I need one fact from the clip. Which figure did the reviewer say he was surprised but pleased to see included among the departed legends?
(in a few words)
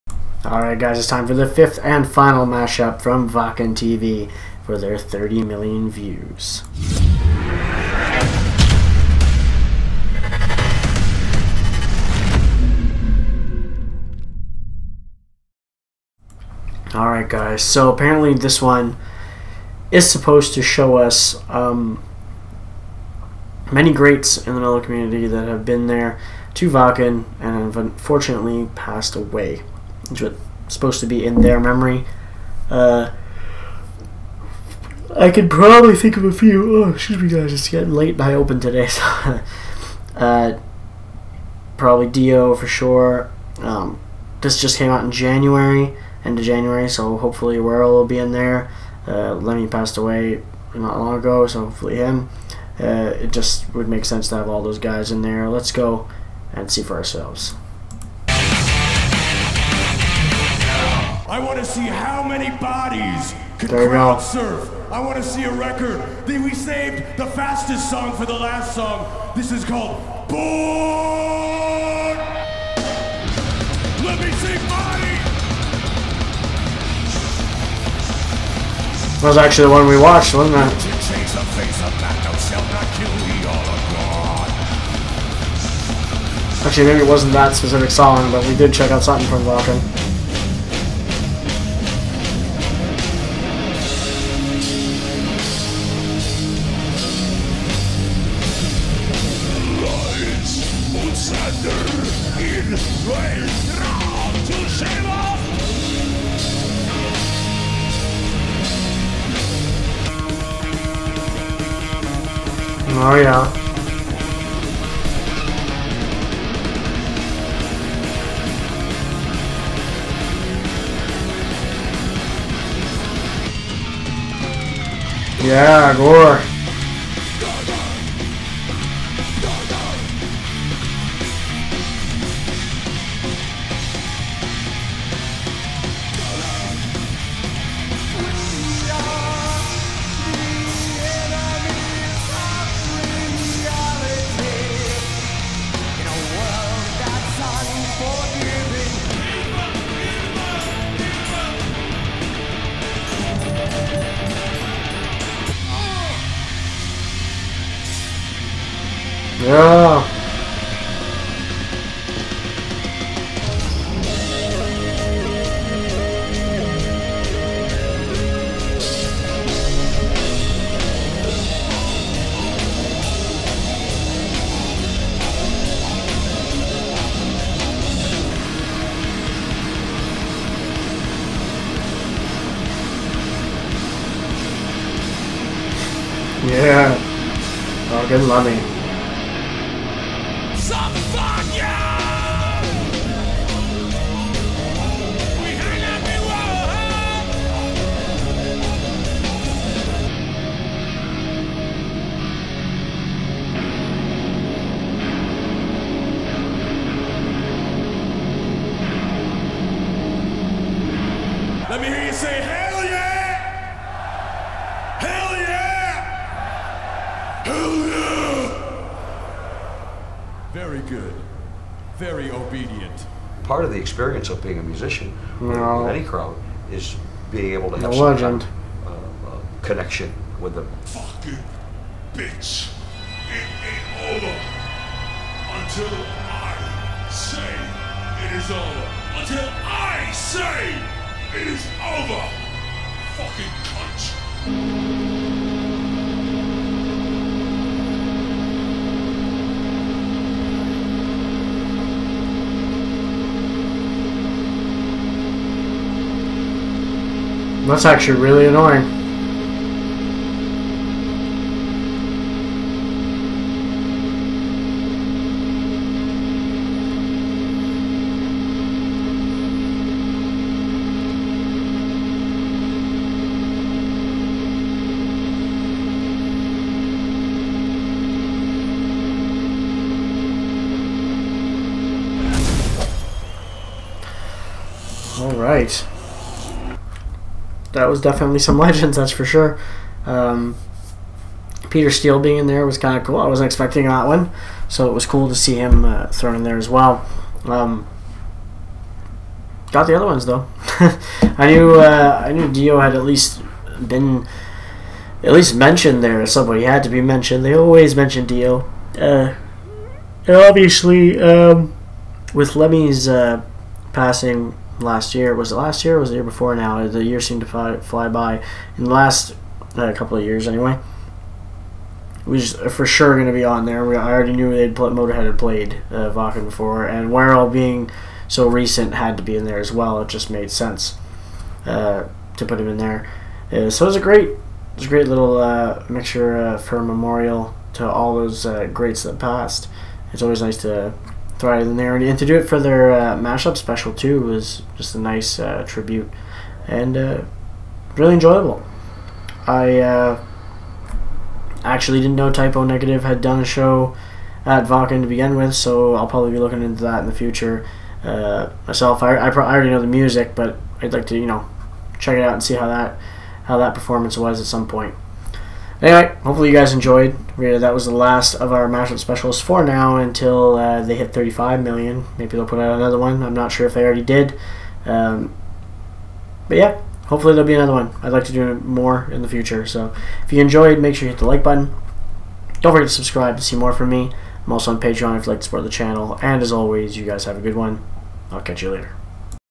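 Peter Steele.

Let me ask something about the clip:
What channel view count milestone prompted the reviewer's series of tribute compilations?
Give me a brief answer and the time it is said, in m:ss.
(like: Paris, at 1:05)
30 million, at 0:04.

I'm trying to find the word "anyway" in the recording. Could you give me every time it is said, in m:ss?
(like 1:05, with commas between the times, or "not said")
5:20, 6:05.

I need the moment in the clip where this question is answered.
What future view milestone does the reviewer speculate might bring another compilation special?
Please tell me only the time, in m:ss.
6:11.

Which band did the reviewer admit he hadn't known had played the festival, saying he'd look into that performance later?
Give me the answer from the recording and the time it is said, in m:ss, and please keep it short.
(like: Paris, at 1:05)
Type O Negative, at 5:52.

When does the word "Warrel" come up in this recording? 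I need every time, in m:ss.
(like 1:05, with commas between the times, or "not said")
0:47, 5:27.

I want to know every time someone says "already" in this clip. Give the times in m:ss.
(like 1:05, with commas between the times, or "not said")
5:24, 5:41, 5:59, 6:13.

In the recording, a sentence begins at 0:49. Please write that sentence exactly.
Uh, Lemmy passed away not long ago, so hopefully him.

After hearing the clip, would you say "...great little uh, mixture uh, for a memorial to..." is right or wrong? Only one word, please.
right.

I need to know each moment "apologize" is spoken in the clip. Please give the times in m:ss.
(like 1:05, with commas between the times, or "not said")
not said.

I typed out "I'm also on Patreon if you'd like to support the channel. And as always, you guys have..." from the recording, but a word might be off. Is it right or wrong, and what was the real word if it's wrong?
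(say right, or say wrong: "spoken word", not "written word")
right.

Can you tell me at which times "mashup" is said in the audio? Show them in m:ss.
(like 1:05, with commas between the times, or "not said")
0:02, 5:43, 6:08.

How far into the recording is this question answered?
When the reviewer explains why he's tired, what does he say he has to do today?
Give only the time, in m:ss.
0:38.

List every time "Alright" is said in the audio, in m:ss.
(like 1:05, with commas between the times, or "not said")
0:00, 0:16.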